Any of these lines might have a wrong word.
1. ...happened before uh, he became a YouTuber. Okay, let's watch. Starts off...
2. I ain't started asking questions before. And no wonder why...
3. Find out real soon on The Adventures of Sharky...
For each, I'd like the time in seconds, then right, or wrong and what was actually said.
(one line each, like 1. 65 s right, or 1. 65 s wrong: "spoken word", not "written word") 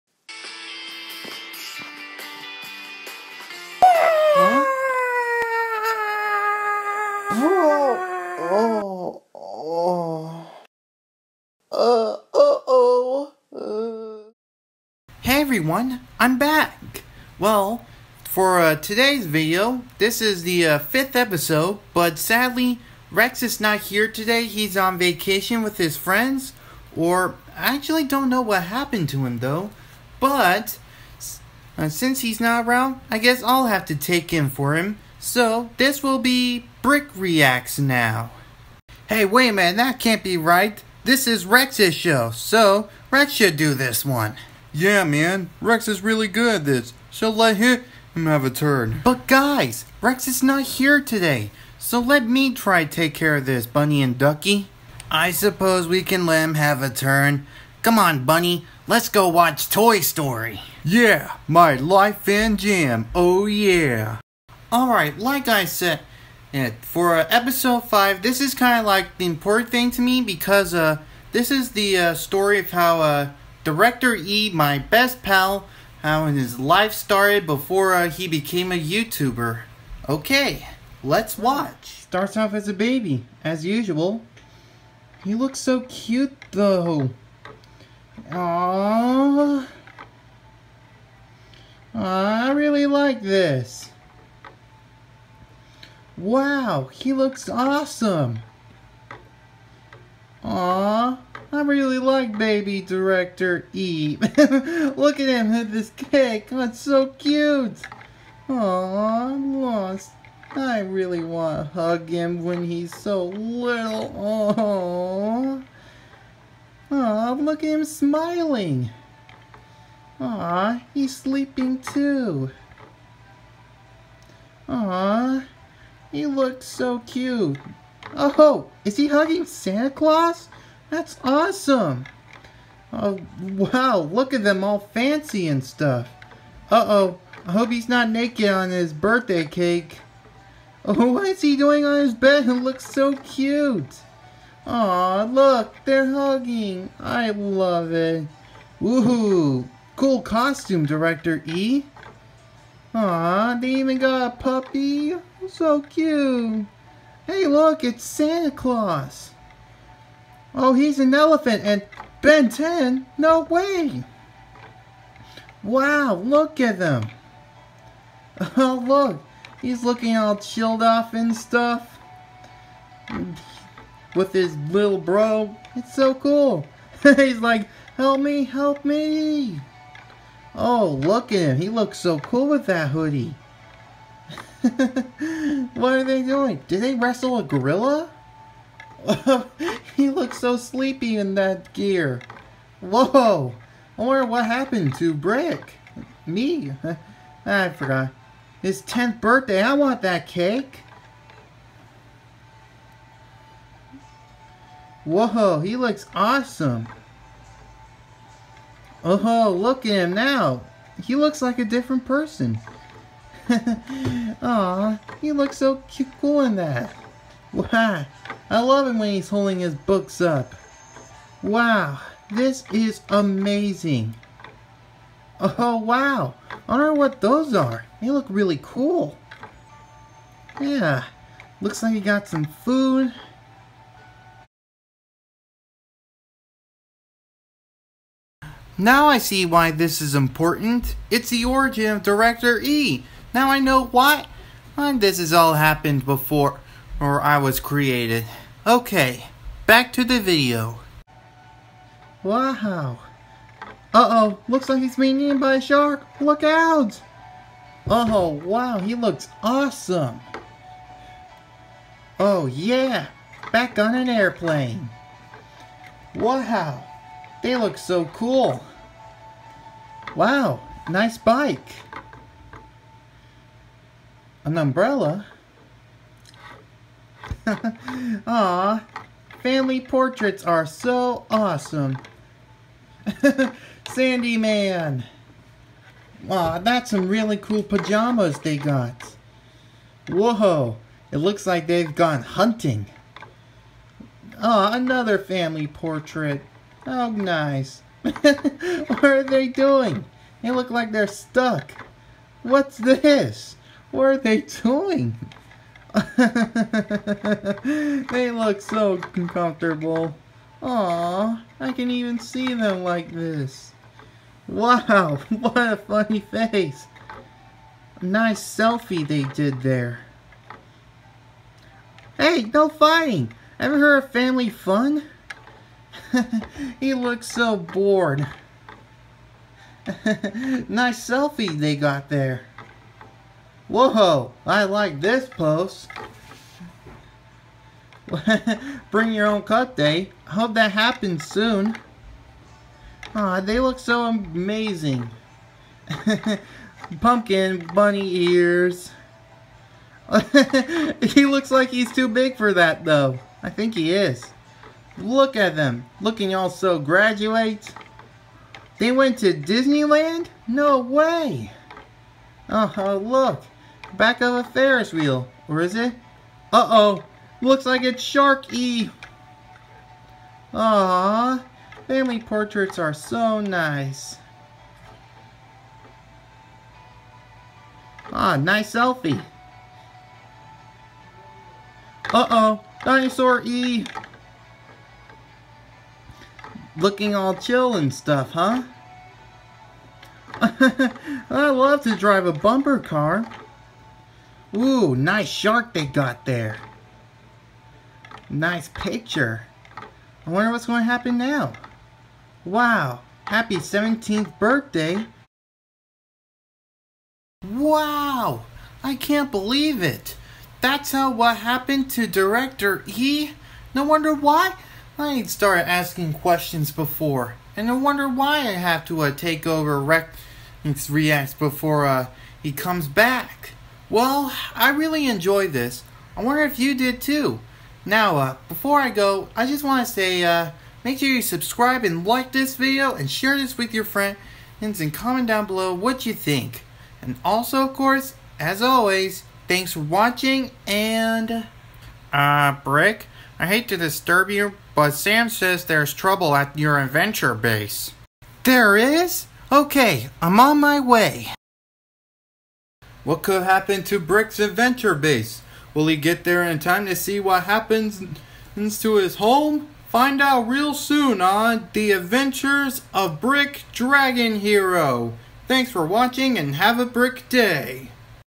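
1. 76 s wrong: "started", not "happened"
2. 414 s right
3. 459 s wrong: "Brick", not "Sharky".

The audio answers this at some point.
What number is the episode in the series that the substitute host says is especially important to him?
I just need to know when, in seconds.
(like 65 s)
67 s.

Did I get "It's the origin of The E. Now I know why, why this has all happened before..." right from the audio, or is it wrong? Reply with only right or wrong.
wrong.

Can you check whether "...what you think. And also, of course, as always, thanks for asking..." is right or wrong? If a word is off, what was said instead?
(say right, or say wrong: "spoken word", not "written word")
wrong: "watching", not "asking".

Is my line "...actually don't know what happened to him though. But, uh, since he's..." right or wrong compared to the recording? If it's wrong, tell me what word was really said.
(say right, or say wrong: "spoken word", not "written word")
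right.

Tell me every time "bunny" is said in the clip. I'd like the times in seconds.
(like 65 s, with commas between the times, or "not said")
53 s, 58 s, 347 s.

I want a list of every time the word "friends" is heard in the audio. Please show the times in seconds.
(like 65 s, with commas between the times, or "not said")
25 s, 433 s.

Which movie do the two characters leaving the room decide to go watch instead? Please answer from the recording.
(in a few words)
Toy Story.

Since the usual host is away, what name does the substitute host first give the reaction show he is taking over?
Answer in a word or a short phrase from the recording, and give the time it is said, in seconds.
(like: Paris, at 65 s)
Brick Reacts, at 36 s.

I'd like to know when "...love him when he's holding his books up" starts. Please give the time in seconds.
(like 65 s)
218 s.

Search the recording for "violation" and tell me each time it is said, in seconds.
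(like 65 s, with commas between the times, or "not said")
not said.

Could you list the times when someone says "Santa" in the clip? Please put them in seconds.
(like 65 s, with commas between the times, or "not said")
129 s, 158 s.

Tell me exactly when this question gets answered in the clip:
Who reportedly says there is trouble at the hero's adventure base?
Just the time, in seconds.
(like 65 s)
444 s.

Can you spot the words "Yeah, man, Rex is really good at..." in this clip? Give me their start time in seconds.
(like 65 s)
44 s.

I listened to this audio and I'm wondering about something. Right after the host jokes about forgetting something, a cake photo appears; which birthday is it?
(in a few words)
10th birthday.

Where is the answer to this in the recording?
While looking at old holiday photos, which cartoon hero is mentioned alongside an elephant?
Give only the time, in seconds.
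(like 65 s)
162 s.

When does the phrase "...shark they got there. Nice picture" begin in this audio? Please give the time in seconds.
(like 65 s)
395 s.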